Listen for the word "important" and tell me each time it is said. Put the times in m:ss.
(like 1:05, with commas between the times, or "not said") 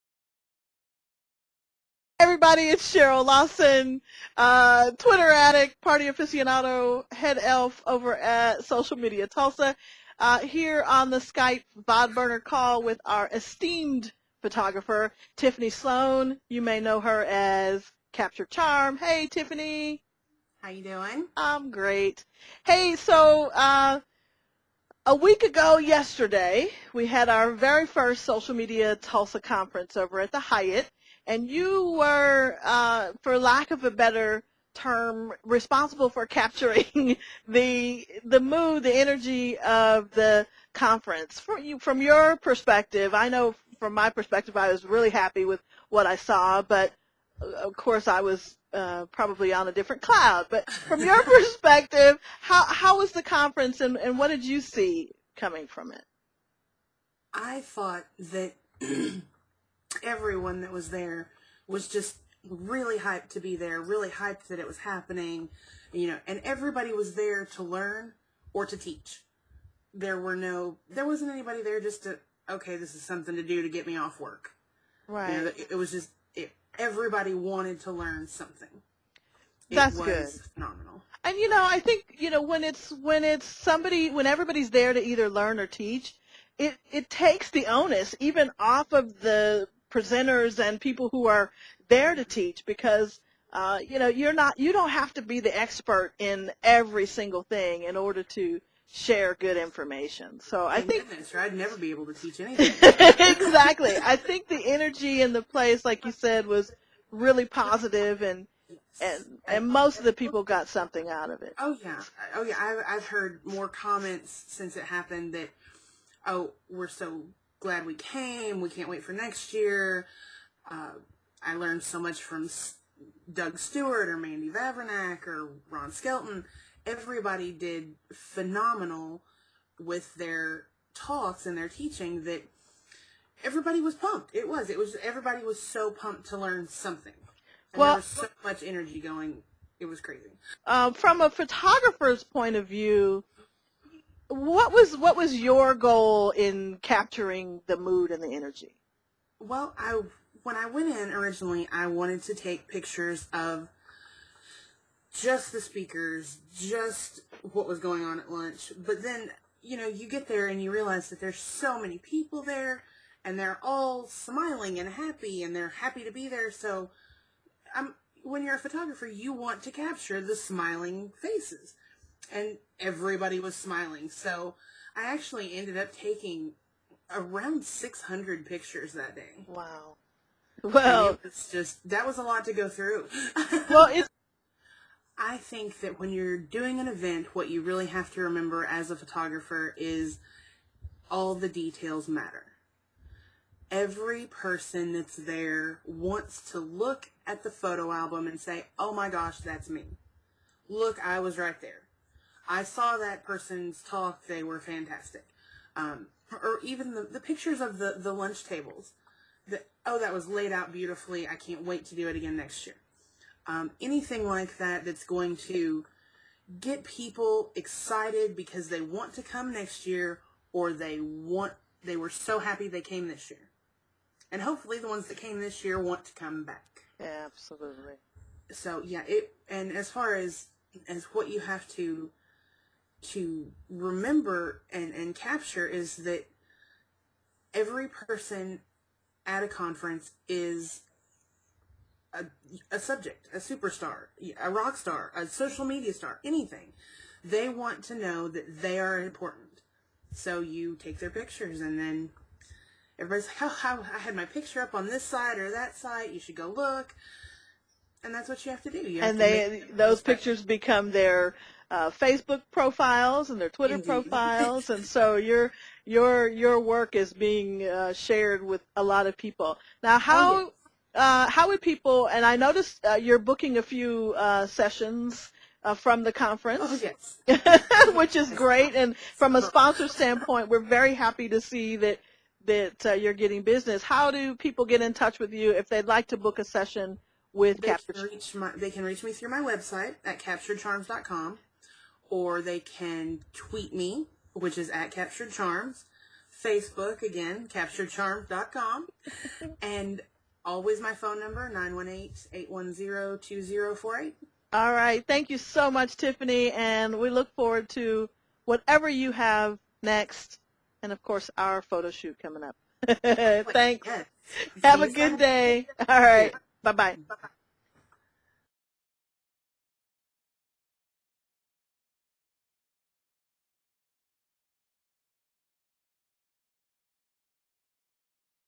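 4:08.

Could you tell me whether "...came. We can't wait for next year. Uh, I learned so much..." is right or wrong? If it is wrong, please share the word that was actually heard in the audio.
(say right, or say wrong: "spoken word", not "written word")
right.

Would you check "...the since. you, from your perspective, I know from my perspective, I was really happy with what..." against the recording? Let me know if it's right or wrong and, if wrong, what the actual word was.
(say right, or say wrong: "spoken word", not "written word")
wrong: "conference", not "since".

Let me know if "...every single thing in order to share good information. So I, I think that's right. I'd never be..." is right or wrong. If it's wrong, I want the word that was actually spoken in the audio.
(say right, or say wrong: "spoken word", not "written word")
right.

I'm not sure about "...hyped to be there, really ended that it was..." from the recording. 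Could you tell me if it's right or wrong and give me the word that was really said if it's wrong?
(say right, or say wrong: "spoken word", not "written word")
wrong: "hyped", not "ended".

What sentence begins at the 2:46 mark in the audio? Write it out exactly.
So I'm, um, when you're a photographer, you want to capture the smiling faces.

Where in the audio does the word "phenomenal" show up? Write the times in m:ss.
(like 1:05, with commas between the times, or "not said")
1:20, 2:08.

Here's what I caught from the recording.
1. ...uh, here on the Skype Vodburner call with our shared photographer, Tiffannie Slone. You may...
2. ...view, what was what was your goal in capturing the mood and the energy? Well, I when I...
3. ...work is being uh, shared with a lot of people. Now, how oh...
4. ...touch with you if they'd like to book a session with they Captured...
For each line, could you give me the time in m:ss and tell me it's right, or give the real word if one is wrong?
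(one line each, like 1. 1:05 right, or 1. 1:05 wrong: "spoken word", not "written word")
1. 0:10 wrong: "esteemed", not "shared"
2. 2:22 right
3. 4:26 right
4. 4:44 right.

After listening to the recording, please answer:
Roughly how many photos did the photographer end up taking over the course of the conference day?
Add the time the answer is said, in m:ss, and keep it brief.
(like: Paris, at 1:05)
600, at 2:57.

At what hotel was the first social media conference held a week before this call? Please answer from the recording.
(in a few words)
Hyatt.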